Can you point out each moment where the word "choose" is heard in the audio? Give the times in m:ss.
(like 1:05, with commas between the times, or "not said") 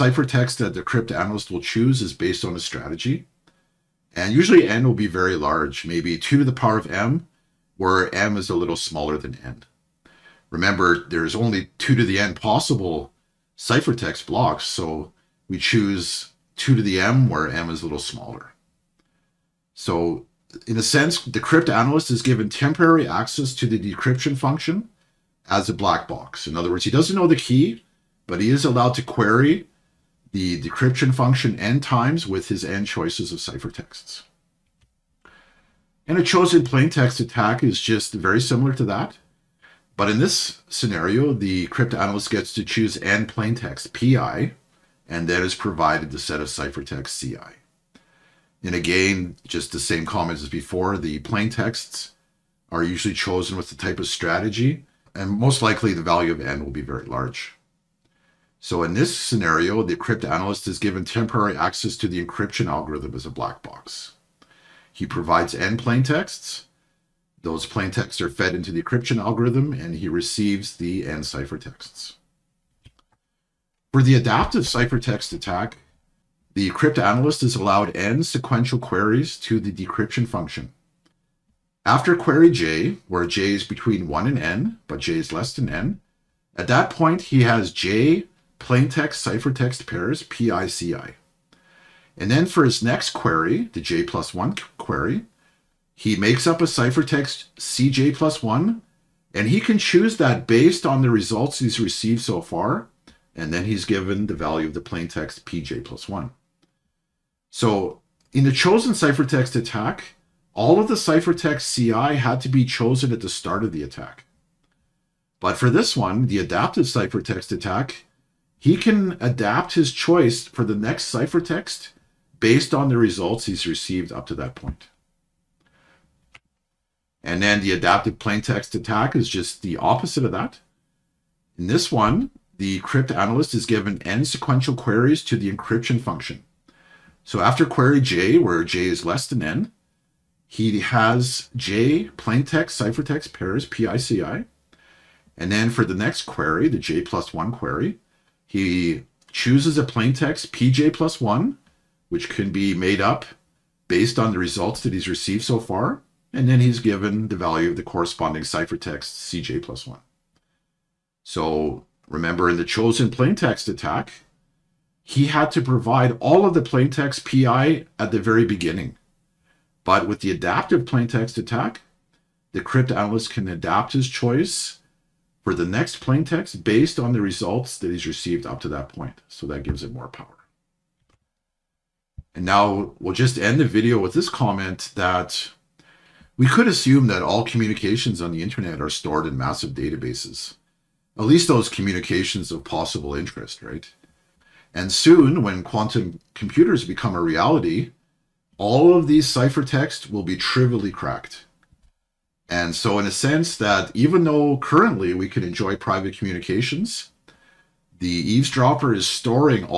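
0:01, 0:15, 0:42, 1:39, 2:29.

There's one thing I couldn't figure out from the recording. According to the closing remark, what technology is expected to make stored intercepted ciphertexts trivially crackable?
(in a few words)
Quantum computers.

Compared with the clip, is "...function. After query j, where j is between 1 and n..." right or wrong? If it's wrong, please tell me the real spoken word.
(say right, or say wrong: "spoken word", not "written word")
right.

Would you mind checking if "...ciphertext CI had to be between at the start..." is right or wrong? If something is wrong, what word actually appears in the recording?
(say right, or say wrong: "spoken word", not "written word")
wrong: "chosen", not "between".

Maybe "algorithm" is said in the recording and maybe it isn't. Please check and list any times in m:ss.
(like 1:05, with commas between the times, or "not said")
1:02, 1:09.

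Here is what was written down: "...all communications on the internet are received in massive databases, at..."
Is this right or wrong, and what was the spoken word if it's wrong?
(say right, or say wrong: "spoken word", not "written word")
wrong: "stored", not "received".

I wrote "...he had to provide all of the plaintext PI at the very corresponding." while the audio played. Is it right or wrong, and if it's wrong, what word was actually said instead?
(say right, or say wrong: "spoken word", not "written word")
wrong: "beginning", not "corresponding".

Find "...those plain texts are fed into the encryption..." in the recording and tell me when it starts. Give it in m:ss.
1:07.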